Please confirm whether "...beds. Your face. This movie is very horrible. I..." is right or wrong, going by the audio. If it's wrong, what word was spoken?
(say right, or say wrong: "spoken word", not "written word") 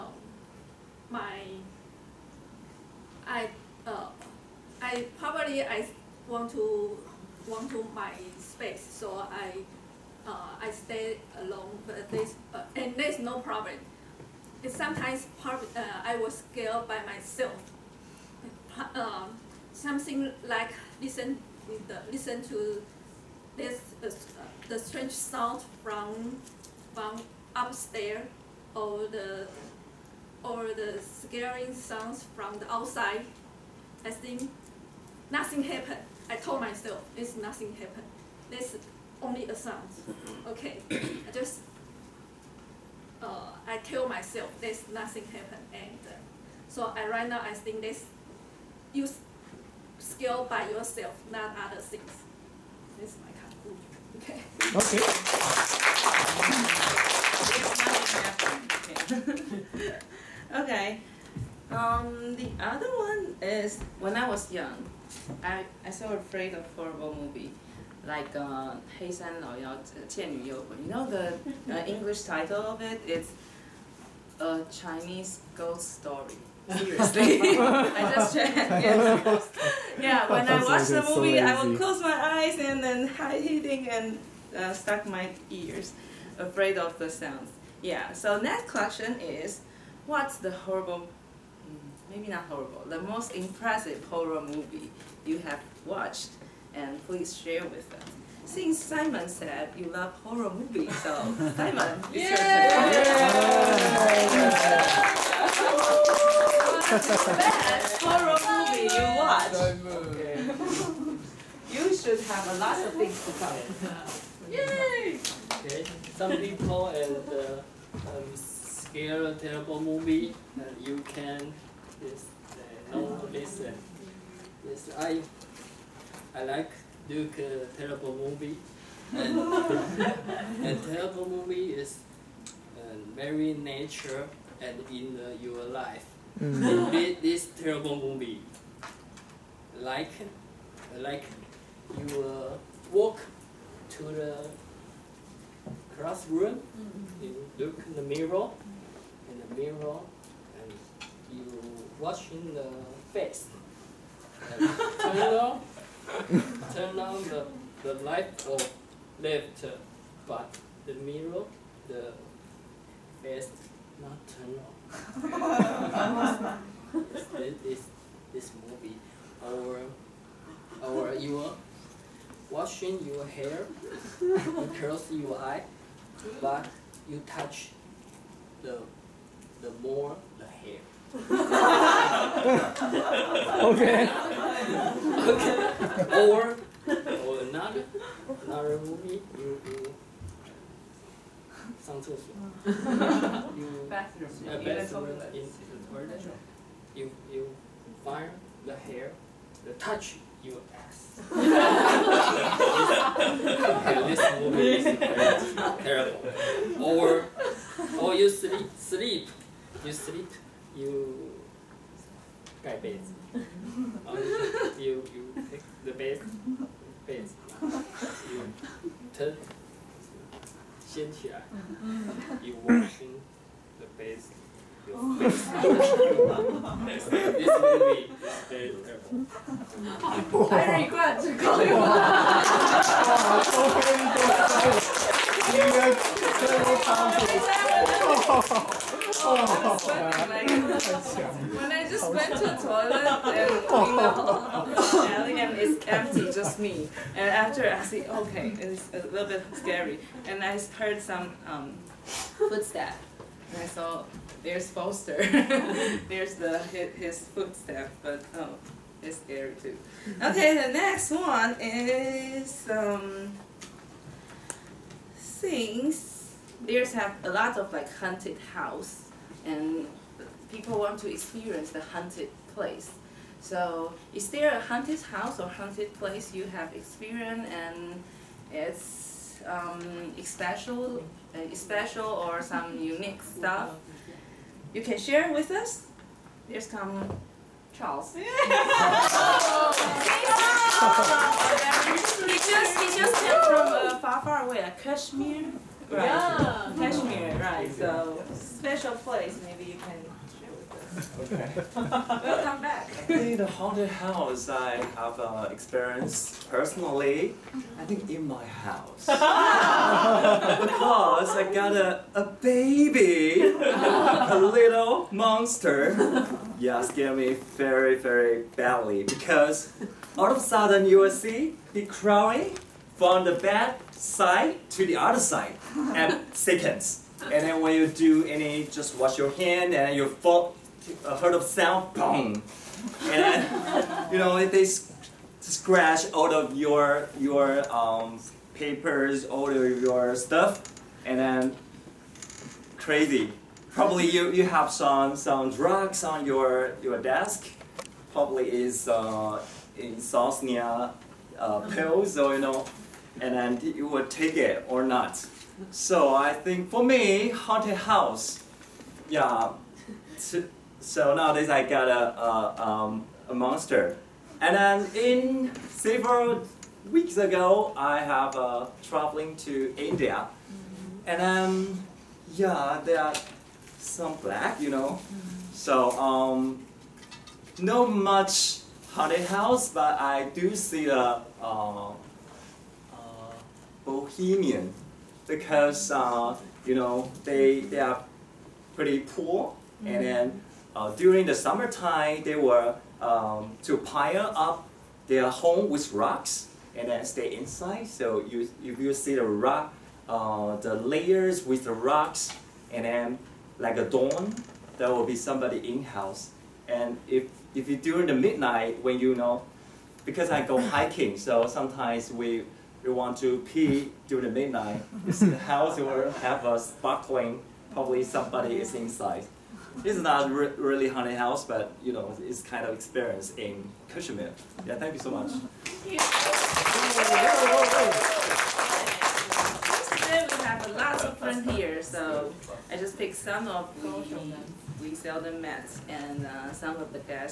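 wrong: "terrible", not "horrible".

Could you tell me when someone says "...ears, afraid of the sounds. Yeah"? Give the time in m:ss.
1:25.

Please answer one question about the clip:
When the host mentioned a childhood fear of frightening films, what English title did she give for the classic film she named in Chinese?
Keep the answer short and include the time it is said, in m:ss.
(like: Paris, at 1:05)
A Chinese Ghost Story, at 1:14.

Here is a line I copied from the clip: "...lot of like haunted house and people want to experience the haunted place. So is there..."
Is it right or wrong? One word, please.
right.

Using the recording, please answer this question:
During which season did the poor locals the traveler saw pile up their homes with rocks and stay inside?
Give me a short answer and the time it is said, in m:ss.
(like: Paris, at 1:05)
Summertime, at 6:31.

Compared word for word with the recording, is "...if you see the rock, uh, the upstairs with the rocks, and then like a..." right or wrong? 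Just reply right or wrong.
wrong.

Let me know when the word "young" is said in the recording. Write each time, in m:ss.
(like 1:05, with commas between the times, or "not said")
1:04.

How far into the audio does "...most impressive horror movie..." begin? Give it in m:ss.
1:33.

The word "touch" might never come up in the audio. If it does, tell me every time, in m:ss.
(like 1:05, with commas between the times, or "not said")
2:57, 3:19.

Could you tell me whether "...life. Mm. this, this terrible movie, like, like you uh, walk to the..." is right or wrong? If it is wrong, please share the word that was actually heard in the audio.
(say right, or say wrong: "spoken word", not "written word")
right.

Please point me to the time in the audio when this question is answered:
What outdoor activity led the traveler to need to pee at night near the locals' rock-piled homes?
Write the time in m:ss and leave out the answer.
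6:50.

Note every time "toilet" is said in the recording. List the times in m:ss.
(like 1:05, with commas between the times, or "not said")
3:15, 4:02.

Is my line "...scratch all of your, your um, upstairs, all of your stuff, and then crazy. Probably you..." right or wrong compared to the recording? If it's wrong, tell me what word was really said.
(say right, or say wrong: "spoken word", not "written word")
wrong: "papers", not "upstairs".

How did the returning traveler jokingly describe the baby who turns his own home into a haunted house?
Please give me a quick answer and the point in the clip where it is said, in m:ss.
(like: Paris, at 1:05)
A little monster, at 5:13.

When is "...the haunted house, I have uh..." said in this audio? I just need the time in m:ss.
5:03.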